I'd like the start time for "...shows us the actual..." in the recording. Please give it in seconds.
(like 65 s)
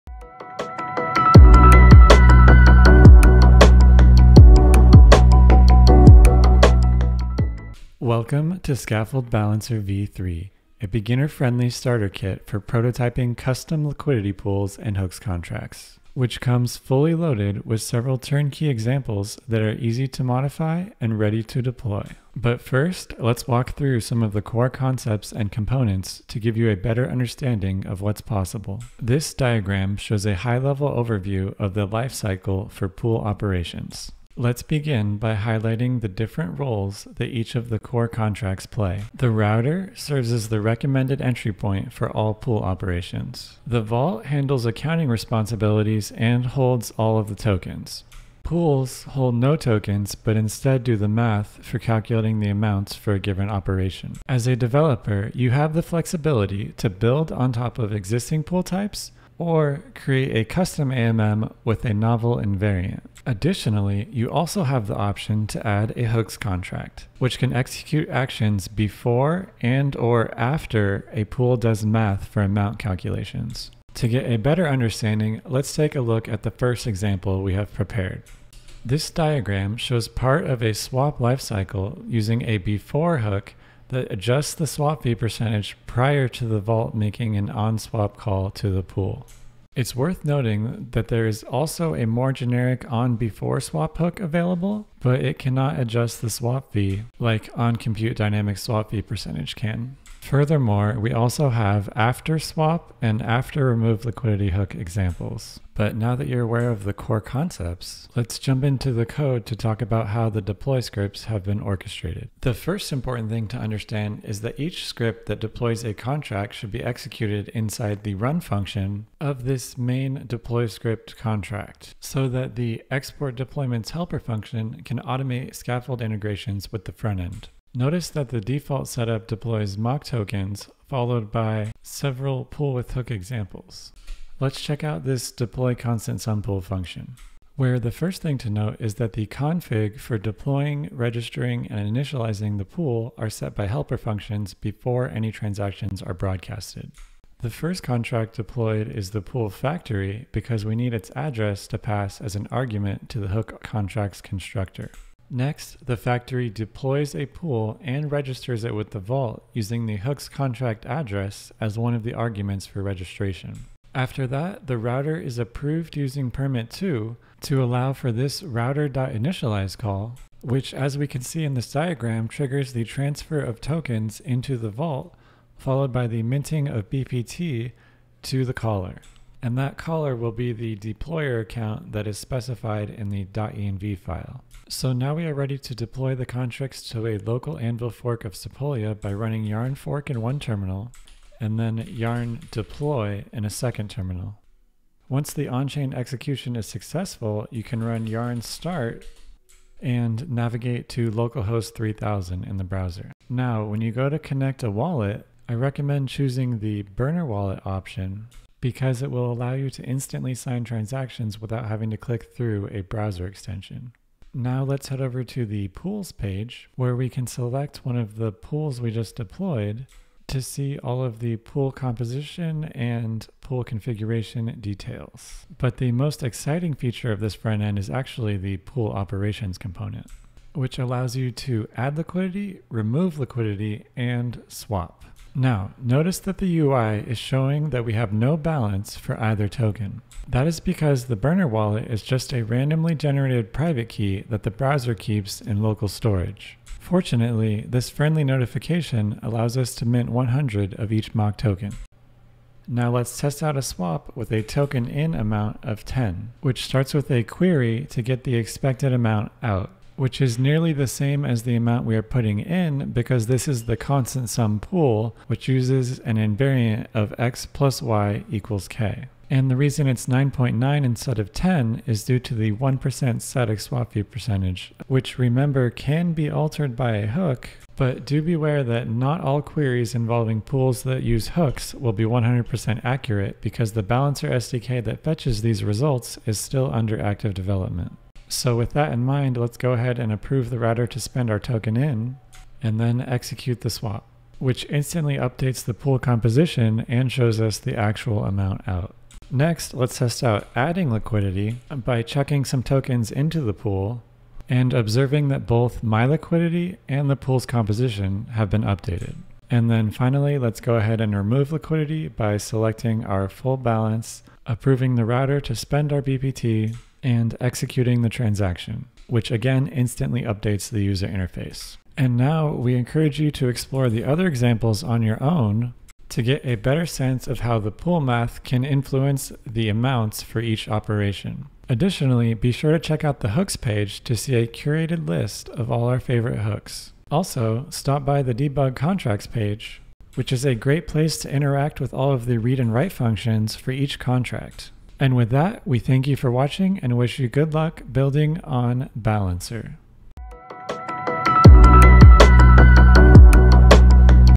297 s.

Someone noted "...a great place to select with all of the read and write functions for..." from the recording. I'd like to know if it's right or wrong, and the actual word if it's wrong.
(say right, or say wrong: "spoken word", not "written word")
wrong: "interact", not "select".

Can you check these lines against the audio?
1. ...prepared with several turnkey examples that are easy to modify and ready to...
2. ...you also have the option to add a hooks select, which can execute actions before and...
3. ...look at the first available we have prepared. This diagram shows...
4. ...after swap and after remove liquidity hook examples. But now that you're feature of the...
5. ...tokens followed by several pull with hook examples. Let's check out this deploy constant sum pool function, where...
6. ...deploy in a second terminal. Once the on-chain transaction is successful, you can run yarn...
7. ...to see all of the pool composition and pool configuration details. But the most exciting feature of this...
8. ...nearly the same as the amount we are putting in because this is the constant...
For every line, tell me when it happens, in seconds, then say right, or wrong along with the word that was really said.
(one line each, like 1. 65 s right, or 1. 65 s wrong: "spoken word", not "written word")
1. 17 s wrong: "loaded", not "prepared"
2. 64 s wrong: "contract", not "select"
3. 76 s wrong: "example", not "available"
4. 101 s wrong: "aware", not "feature"
5. 130 s right
6. 192 s wrong: "execution", not "transaction"
7. 220 s right
8. 260 s right.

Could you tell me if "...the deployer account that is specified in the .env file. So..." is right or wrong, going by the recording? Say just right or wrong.
right.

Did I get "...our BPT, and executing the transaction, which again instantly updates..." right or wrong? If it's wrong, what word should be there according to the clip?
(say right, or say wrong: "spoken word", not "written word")
right.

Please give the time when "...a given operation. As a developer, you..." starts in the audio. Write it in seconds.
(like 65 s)
53 s.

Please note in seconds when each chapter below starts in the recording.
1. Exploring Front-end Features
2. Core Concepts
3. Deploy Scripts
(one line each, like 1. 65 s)
1. 185 s
2. 22 s
3. 110 s.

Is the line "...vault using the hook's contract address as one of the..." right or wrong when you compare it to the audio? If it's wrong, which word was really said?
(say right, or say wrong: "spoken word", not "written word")
right.